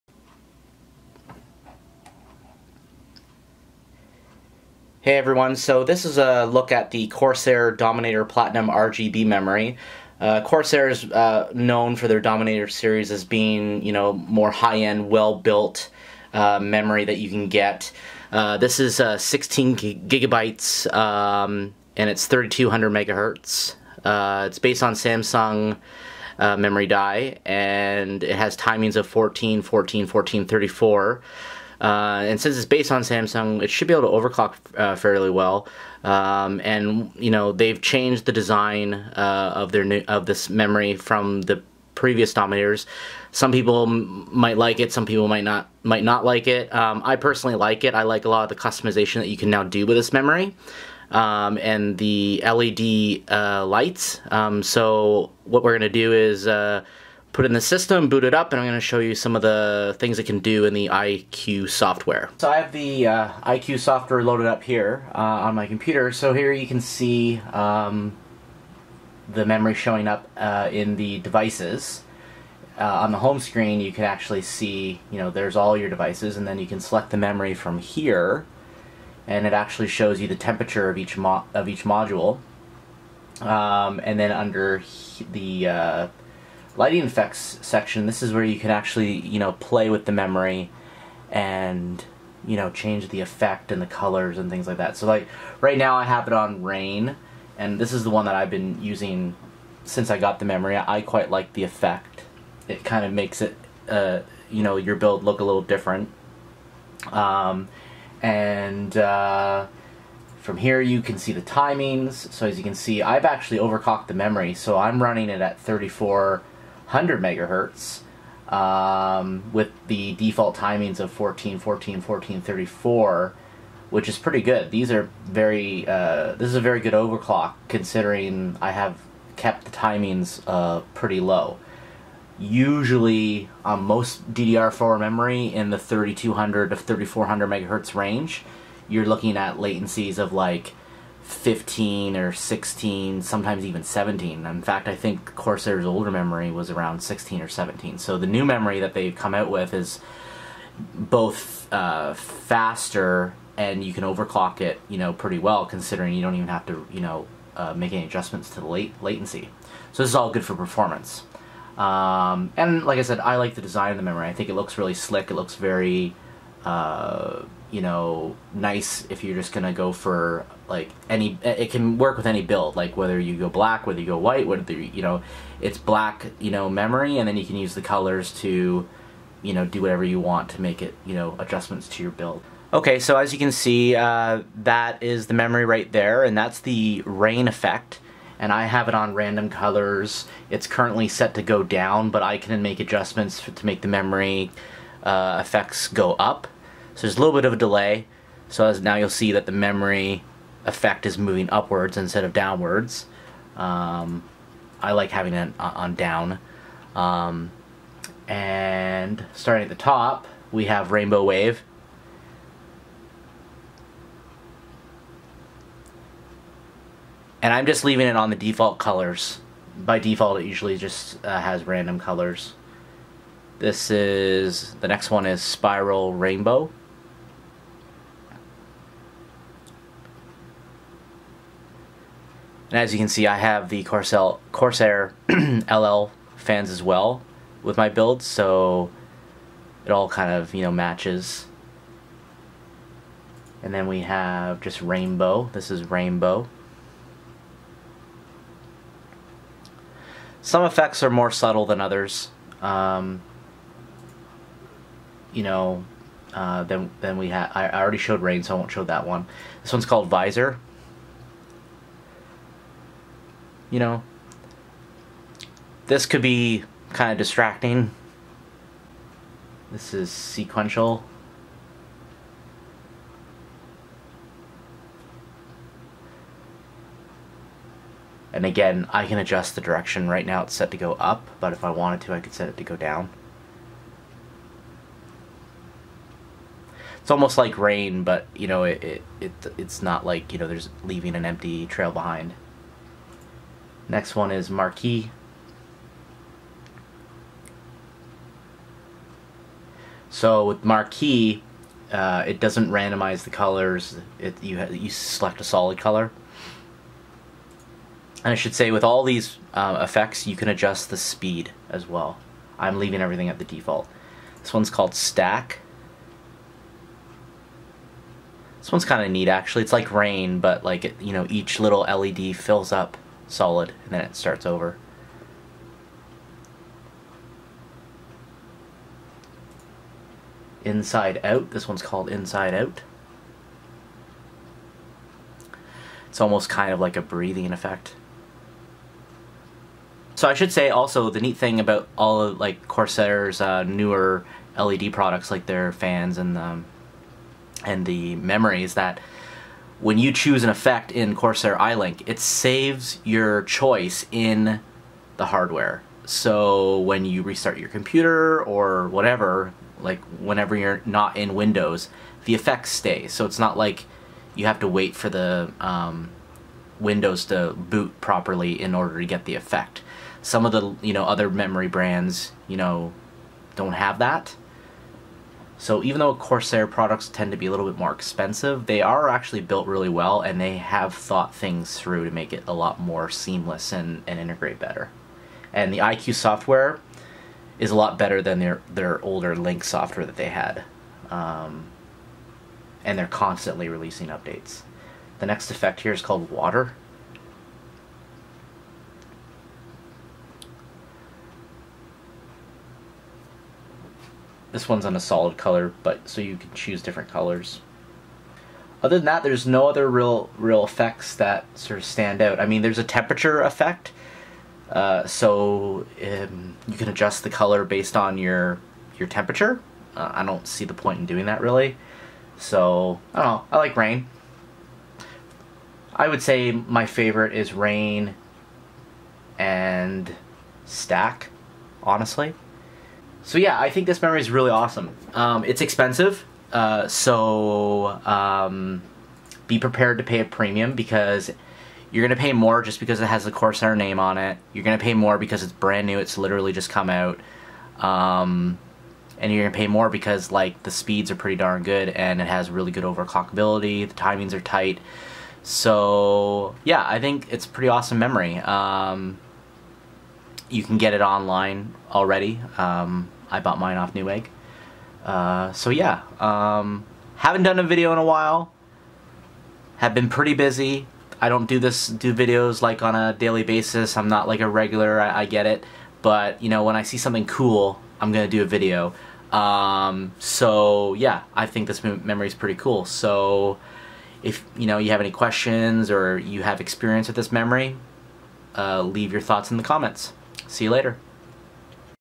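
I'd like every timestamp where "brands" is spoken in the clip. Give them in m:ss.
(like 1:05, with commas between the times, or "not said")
6:11, 7:25.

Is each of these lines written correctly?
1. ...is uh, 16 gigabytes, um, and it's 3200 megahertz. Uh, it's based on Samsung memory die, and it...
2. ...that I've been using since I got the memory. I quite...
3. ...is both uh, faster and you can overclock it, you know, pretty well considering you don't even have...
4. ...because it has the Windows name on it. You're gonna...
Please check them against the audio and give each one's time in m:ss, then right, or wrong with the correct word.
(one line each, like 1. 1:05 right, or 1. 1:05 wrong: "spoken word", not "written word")
1. 0:18 right
2. 1:38 right
3. 2:29 right
4. 7:22 wrong: "Corsair", not "Windows".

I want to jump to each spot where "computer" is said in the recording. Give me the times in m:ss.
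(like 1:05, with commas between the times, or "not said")
1:05, 5:57.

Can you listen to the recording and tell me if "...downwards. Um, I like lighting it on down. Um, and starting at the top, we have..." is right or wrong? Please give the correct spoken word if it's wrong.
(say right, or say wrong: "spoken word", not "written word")
wrong: "having", not "lighting".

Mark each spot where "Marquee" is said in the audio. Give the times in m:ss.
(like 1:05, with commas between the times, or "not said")
4:54, 5:00.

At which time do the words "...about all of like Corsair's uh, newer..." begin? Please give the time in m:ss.
5:41.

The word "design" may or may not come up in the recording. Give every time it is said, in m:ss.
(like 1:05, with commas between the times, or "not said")
0:38, 2:43.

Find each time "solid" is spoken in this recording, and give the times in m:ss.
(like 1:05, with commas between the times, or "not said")
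5:05, 5:23, 6:44.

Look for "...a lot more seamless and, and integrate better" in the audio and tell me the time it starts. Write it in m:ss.
6:22.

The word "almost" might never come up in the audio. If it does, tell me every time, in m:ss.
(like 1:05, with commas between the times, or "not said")
4:47, 5:36.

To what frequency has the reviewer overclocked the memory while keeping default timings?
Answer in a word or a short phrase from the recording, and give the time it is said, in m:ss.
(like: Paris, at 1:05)
3400 MHz, at 1:55.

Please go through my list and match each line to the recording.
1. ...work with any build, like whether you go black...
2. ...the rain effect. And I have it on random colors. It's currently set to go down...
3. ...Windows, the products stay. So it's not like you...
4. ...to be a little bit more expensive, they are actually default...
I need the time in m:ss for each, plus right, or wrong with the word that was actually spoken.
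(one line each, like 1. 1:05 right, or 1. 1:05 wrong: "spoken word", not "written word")
1. 2:51 right
2. 3:06 right
3. 6:01 wrong: "effects", not "products"
4. 6:17 wrong: "built", not "default".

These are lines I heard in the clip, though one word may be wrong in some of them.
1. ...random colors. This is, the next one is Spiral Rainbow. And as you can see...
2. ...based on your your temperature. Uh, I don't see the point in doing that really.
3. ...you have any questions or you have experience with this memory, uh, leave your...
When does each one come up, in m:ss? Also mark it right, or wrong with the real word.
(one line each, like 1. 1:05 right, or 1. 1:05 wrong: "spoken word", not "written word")
1. 3:41 right
2. 6:57 right
3. 8:04 right.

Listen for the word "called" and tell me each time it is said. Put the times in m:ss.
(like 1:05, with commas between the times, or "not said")
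4:19, 5:14, 5:31, 6:36.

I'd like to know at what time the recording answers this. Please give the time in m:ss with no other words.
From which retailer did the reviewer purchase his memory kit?
7:43.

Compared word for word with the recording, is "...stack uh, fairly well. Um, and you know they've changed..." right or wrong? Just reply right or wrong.
wrong.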